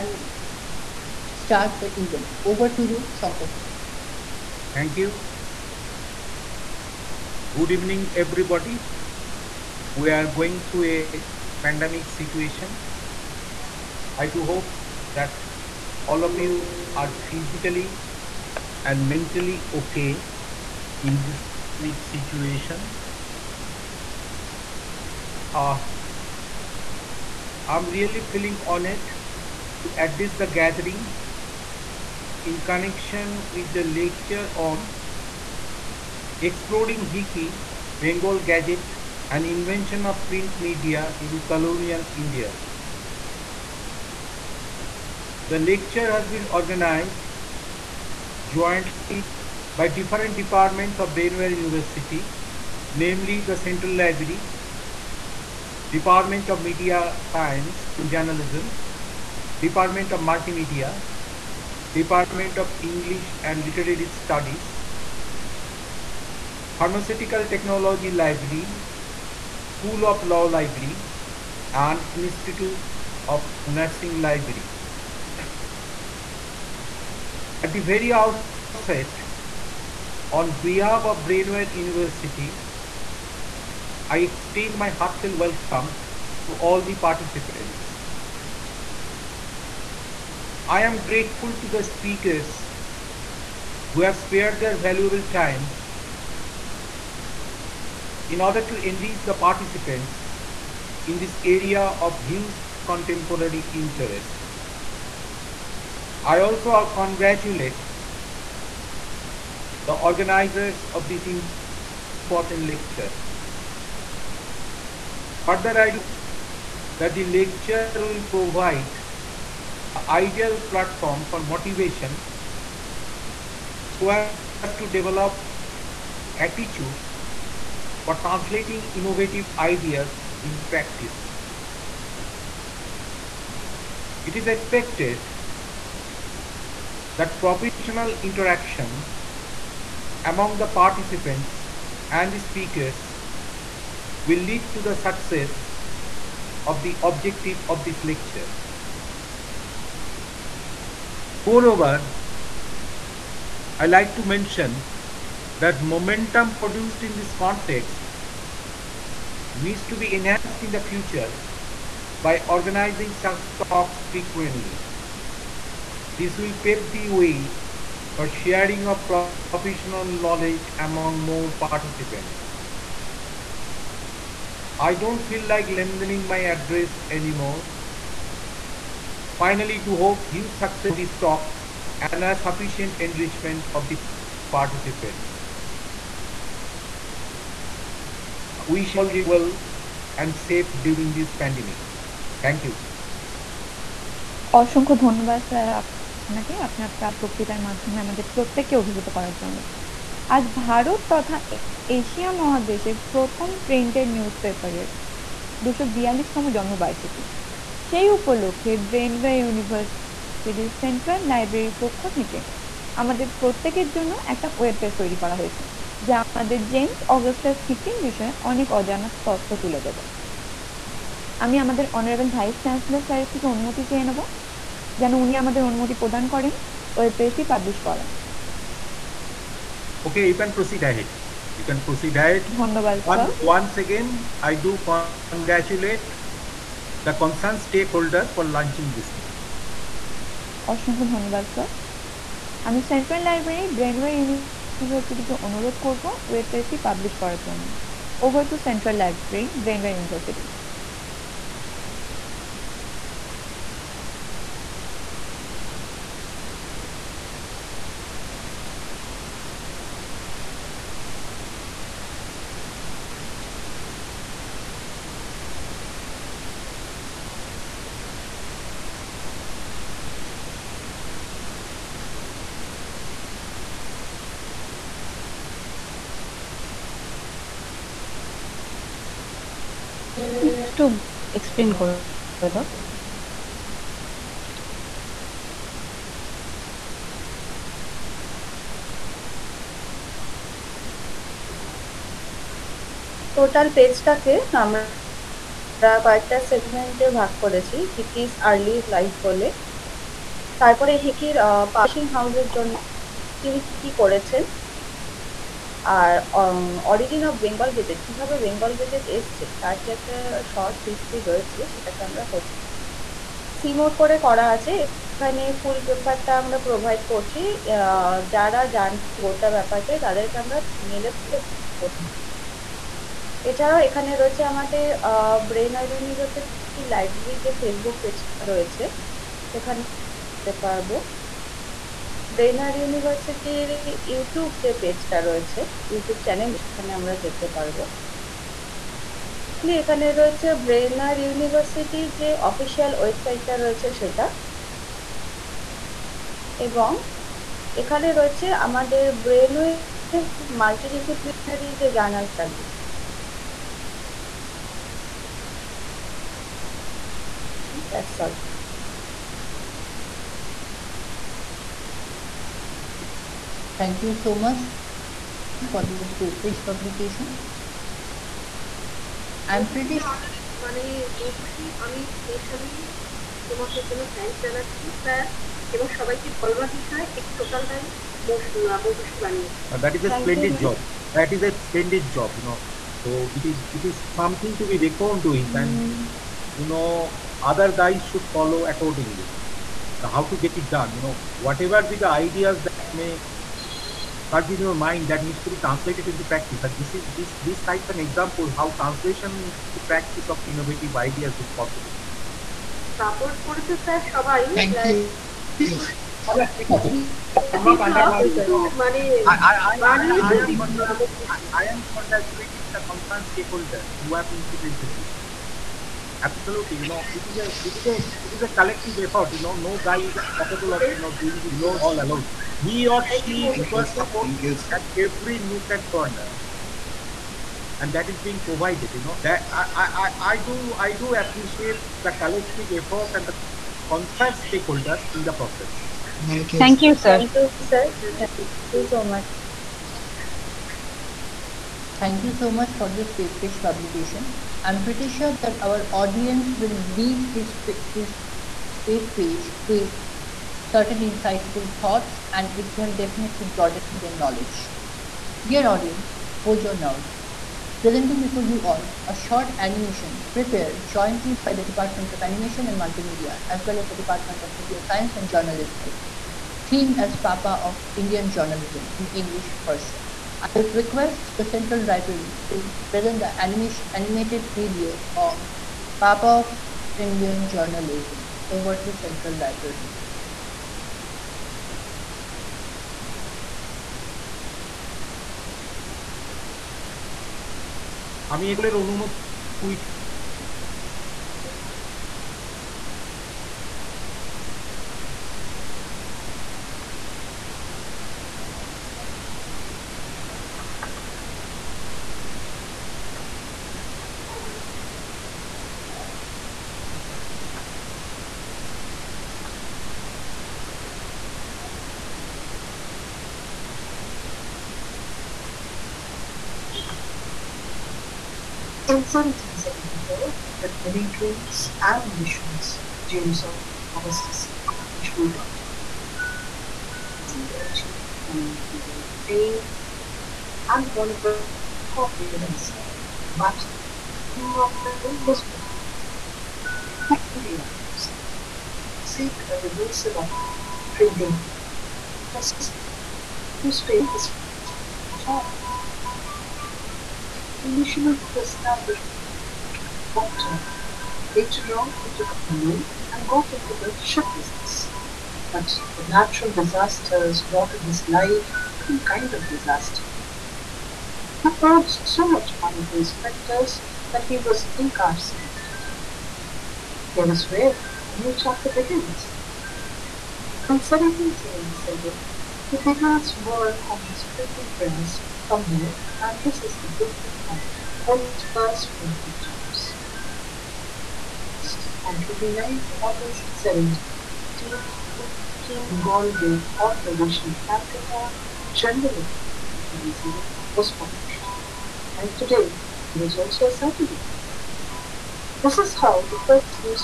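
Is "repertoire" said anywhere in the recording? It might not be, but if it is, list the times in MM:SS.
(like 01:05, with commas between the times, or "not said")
not said.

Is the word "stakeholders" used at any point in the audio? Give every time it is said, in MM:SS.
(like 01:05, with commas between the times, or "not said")
03:57, 06:53, 07:14.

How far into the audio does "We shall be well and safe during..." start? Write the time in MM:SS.
03:08.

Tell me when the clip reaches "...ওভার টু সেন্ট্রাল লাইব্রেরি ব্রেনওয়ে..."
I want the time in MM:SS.
04:08.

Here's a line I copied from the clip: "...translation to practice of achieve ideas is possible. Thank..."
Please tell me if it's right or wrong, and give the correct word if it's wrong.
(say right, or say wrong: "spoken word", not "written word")
wrong: "innovative", not "achieve".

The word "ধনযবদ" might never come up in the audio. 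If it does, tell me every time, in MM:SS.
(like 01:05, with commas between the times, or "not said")
03:15, 03:52, 04:01.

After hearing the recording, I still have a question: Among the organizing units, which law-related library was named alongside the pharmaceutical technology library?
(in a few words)
School of Law Library.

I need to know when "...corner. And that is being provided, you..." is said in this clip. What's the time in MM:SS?
07:05.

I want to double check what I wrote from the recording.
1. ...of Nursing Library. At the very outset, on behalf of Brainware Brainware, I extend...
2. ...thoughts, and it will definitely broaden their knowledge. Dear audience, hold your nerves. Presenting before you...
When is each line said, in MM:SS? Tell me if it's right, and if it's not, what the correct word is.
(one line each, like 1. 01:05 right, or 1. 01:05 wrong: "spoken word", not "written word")
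1. 01:13 wrong: "University", not "Brainware"
2. 07:31 right.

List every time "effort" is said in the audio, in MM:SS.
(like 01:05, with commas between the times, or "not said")
06:59, 07:12.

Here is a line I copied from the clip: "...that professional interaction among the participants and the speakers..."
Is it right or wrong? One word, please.
right.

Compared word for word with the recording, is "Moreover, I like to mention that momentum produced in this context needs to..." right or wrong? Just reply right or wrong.
right.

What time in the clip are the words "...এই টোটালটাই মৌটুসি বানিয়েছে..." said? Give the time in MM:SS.
06:17.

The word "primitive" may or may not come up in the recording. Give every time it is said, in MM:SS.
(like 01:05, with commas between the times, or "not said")
not said.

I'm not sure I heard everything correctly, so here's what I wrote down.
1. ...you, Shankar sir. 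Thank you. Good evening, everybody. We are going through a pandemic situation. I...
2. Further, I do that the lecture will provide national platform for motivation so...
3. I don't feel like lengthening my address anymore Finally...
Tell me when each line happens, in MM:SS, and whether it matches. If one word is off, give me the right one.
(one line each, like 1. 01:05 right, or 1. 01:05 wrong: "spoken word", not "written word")
1. 00:02 right
2. 01:55 wrong: "ideal", not "national"
3. 02:54 right.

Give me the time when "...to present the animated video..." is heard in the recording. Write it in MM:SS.
07:52.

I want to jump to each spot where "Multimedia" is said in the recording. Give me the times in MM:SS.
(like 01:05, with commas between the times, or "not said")
01:00, 07:42.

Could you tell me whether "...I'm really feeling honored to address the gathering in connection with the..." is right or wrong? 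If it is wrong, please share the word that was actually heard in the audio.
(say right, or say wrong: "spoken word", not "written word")
right.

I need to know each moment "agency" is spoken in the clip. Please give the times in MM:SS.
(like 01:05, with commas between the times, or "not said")
not said.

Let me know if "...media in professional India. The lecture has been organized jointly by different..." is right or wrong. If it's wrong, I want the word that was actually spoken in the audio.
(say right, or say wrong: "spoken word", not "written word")
wrong: "colonial", not "professional".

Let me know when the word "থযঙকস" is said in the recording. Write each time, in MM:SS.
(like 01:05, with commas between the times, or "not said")
06:14.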